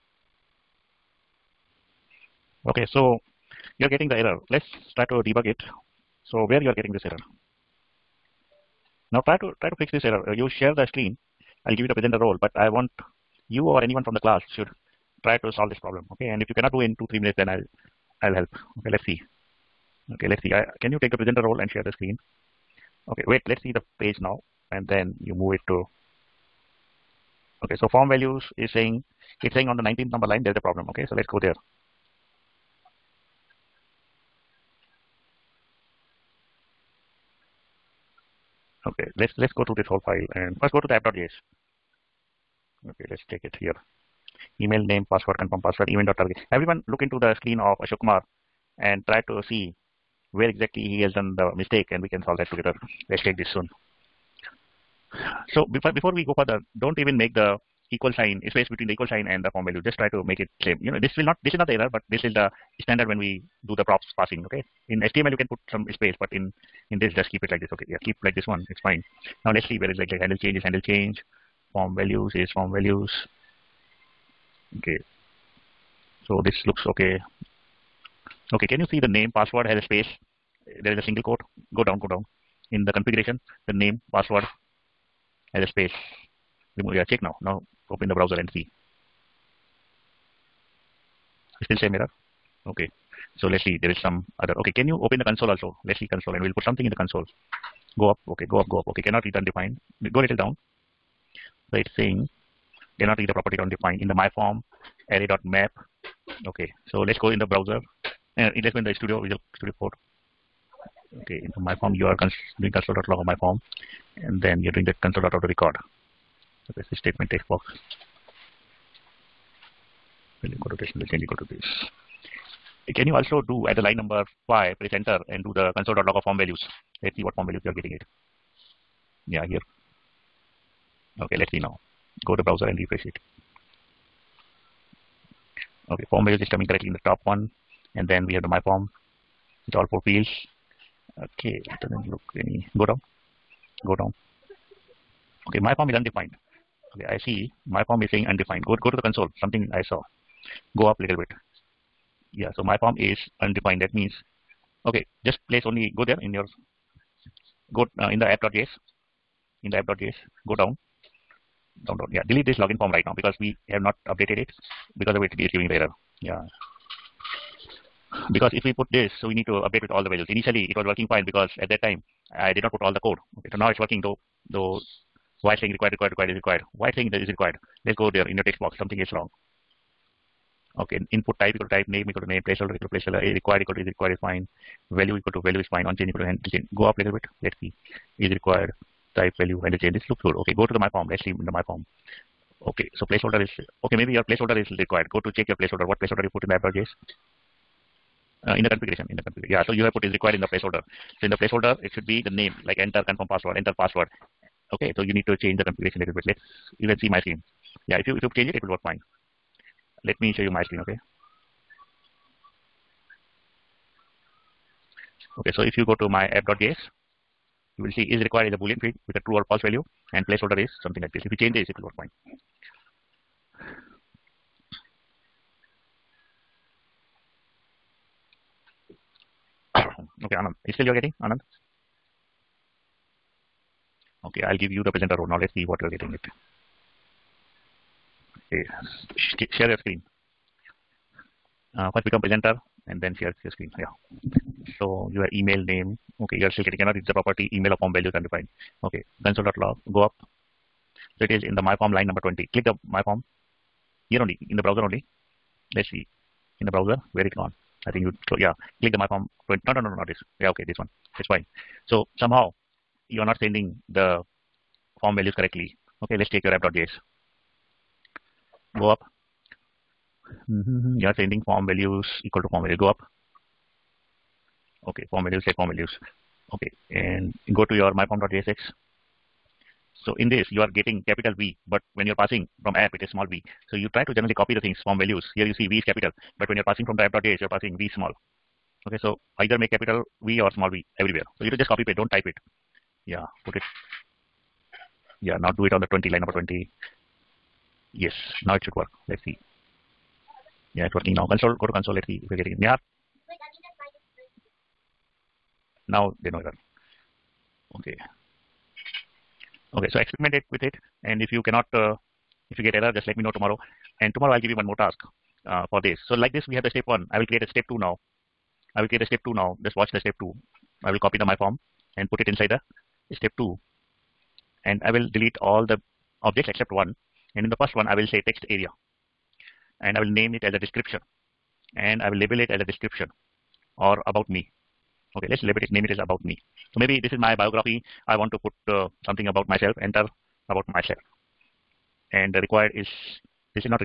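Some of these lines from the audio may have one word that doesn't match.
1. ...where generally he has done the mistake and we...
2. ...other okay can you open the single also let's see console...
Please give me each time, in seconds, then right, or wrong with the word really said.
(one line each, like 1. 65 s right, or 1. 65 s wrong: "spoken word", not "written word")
1. 50 s wrong: "exactly", not "generally"
2. 94 s wrong: "console", not "single".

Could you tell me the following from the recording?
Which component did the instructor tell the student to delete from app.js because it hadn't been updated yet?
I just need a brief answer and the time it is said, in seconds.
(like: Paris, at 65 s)
login form, at 162 s.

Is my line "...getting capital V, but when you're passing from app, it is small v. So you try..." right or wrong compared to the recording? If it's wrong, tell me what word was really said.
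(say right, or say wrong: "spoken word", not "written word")
right.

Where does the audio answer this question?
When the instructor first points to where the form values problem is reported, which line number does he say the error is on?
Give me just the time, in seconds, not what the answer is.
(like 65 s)
29 s.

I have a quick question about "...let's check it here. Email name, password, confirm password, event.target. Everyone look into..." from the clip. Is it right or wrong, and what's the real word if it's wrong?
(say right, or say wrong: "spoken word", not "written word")
right.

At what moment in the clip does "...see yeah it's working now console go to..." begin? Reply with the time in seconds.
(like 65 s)
299 s.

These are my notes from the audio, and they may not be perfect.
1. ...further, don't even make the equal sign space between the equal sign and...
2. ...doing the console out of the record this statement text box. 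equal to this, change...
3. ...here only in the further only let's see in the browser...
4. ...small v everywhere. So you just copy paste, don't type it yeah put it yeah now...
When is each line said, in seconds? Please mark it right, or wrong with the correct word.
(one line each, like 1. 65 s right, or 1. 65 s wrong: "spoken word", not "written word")
1. 56 s right
2. 114 s right
3. 254 s wrong: "browser", not "further"
4. 290 s right.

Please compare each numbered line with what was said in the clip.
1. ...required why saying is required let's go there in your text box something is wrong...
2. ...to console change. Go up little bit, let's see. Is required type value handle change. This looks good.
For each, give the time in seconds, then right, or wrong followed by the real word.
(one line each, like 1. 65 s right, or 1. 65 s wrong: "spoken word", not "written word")
1. 176 s right
2. 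186 s wrong: "handle", not "console".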